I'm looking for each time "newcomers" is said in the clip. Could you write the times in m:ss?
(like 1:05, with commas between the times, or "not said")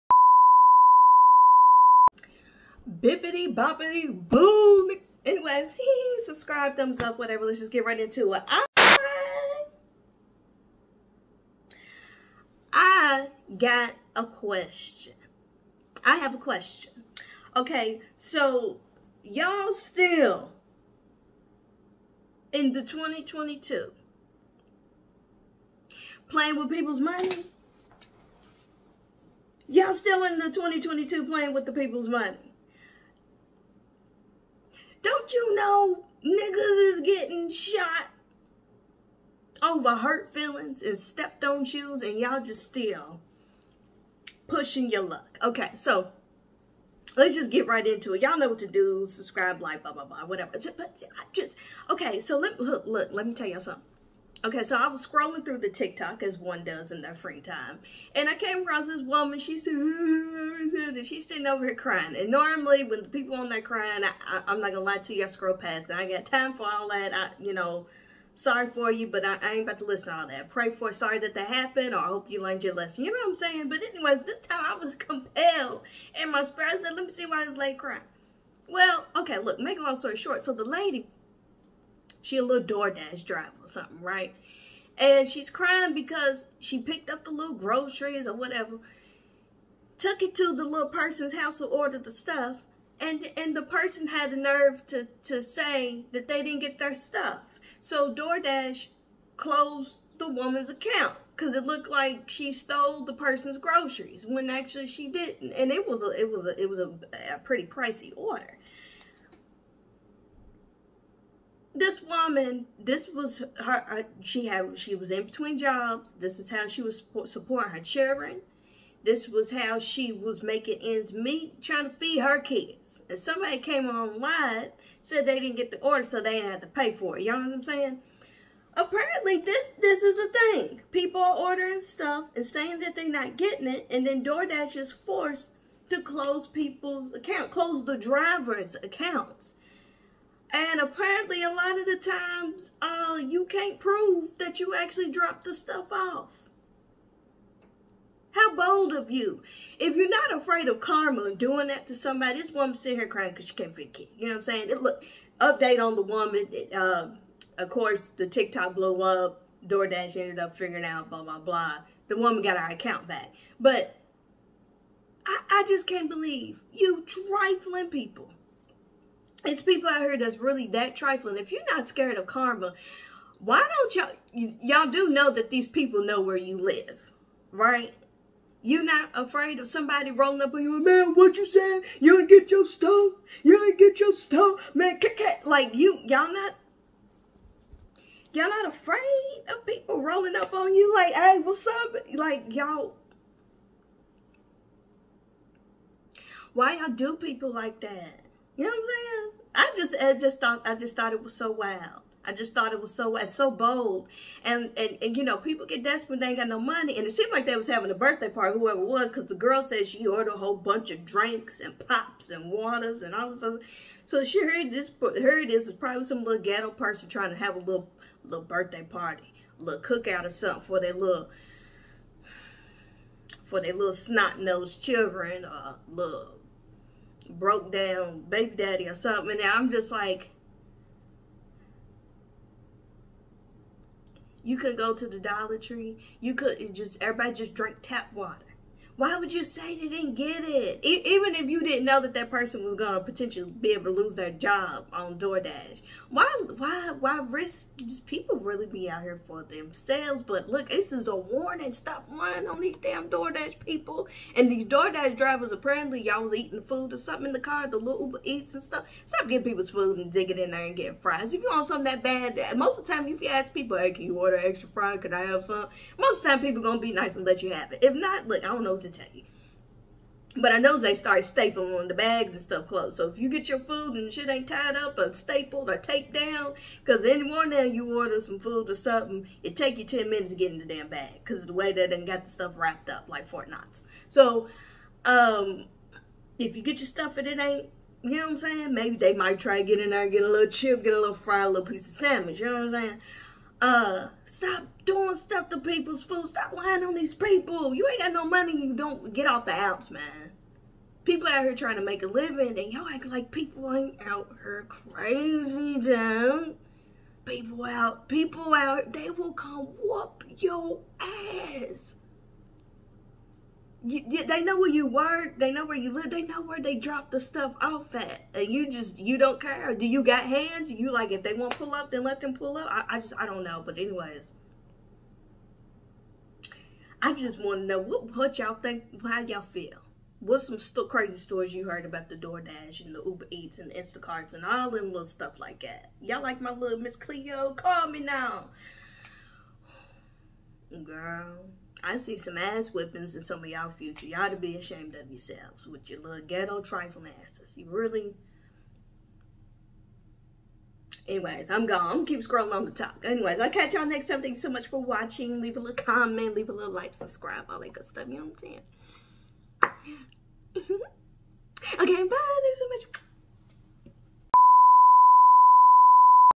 not said.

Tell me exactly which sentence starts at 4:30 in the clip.
But I know they started stapling on the bags and stuff closed.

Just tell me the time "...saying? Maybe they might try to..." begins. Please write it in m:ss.
4:48.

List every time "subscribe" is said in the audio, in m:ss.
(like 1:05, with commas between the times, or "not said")
0:06, 0:49, 5:56.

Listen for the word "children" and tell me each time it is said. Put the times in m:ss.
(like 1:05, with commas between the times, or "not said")
1:57, 3:44.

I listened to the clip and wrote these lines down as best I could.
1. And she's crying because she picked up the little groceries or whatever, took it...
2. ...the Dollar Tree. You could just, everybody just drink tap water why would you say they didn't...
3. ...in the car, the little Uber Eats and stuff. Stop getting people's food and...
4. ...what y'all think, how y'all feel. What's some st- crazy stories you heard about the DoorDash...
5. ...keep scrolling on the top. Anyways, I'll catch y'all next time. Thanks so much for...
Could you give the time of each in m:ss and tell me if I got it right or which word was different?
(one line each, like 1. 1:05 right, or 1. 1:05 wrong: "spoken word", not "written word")
1. 1:24 right
2. 3:55 right
3. 4:17 right
4. 5:28 right
5. 5:52 right.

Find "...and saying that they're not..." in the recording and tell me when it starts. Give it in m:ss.
2:12.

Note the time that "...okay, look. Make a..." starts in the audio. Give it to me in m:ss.
1:19.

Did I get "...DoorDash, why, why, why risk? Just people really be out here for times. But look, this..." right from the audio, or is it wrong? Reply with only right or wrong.
wrong.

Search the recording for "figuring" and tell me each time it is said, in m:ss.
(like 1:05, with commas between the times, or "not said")
2:40.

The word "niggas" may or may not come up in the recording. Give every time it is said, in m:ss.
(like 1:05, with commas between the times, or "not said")
0:36.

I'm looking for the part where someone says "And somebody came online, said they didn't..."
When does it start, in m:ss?
2:03.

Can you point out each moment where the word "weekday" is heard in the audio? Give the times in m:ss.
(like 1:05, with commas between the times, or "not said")
not said.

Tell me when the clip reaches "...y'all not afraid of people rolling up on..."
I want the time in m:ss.
3:08.